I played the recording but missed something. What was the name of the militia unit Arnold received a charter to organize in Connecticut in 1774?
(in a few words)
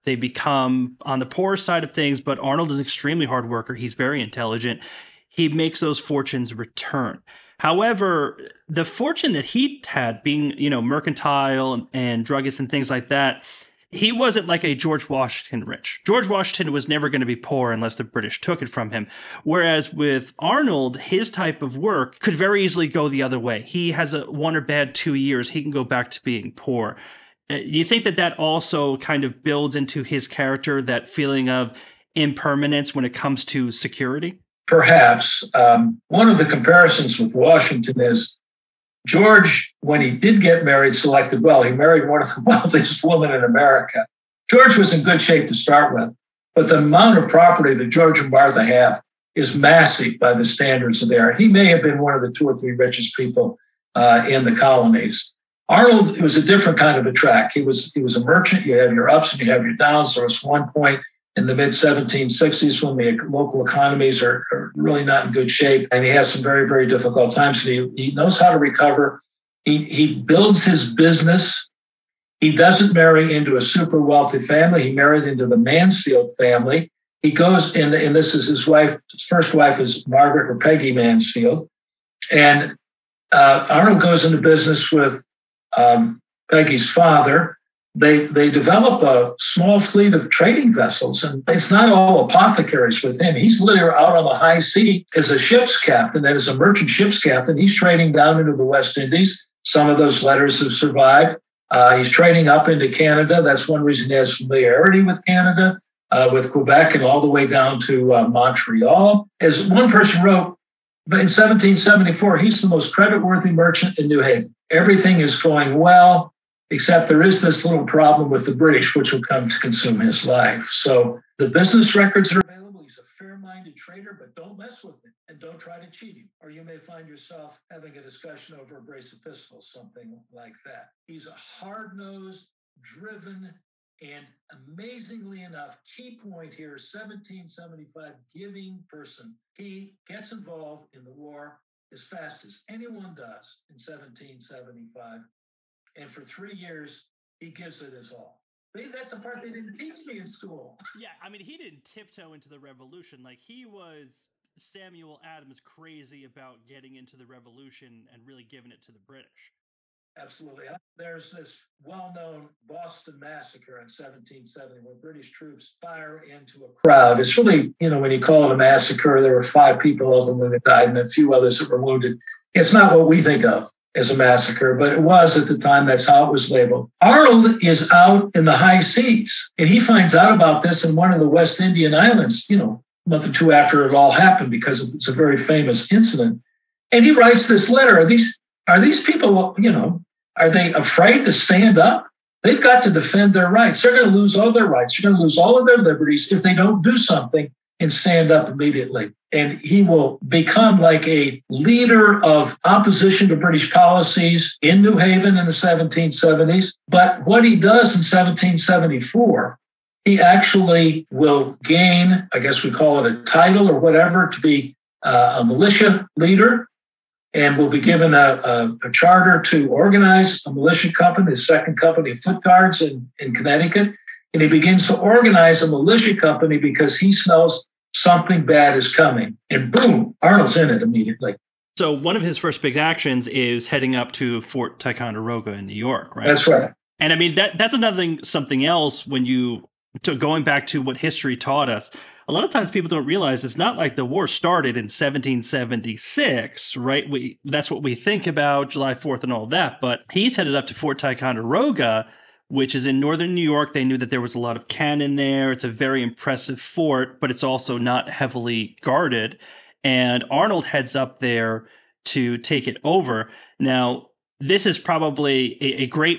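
Second Company of Foot Guards.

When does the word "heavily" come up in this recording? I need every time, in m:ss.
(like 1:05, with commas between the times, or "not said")
4:18.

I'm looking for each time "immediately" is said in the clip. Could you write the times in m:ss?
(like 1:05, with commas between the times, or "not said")
3:18, 3:50.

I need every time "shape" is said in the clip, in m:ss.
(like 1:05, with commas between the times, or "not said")
0:45, 1:05.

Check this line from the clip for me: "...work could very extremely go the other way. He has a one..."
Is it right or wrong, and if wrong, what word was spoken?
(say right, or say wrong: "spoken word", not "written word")
wrong: "easily", not "extremely".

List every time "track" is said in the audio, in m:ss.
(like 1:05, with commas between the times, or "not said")
0:57.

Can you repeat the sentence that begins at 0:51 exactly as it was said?
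He may have been one of the two or three richest people uh, in the colonies.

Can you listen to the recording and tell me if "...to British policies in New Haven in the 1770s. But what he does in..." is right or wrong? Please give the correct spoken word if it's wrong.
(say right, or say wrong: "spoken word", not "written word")
right.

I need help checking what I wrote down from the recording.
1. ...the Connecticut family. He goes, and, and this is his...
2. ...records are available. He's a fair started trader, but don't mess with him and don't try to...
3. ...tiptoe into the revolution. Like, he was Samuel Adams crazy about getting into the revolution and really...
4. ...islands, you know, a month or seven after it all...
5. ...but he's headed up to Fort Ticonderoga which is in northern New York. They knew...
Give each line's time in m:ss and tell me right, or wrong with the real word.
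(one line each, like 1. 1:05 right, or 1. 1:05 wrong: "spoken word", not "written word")
1. 1:15 wrong: "Mansfield", not "Connecticut"
2. 2:01 wrong: "minded", not "started"
3. 2:31 right
4. 3:01 wrong: "two", not "seven"
5. 4:09 right.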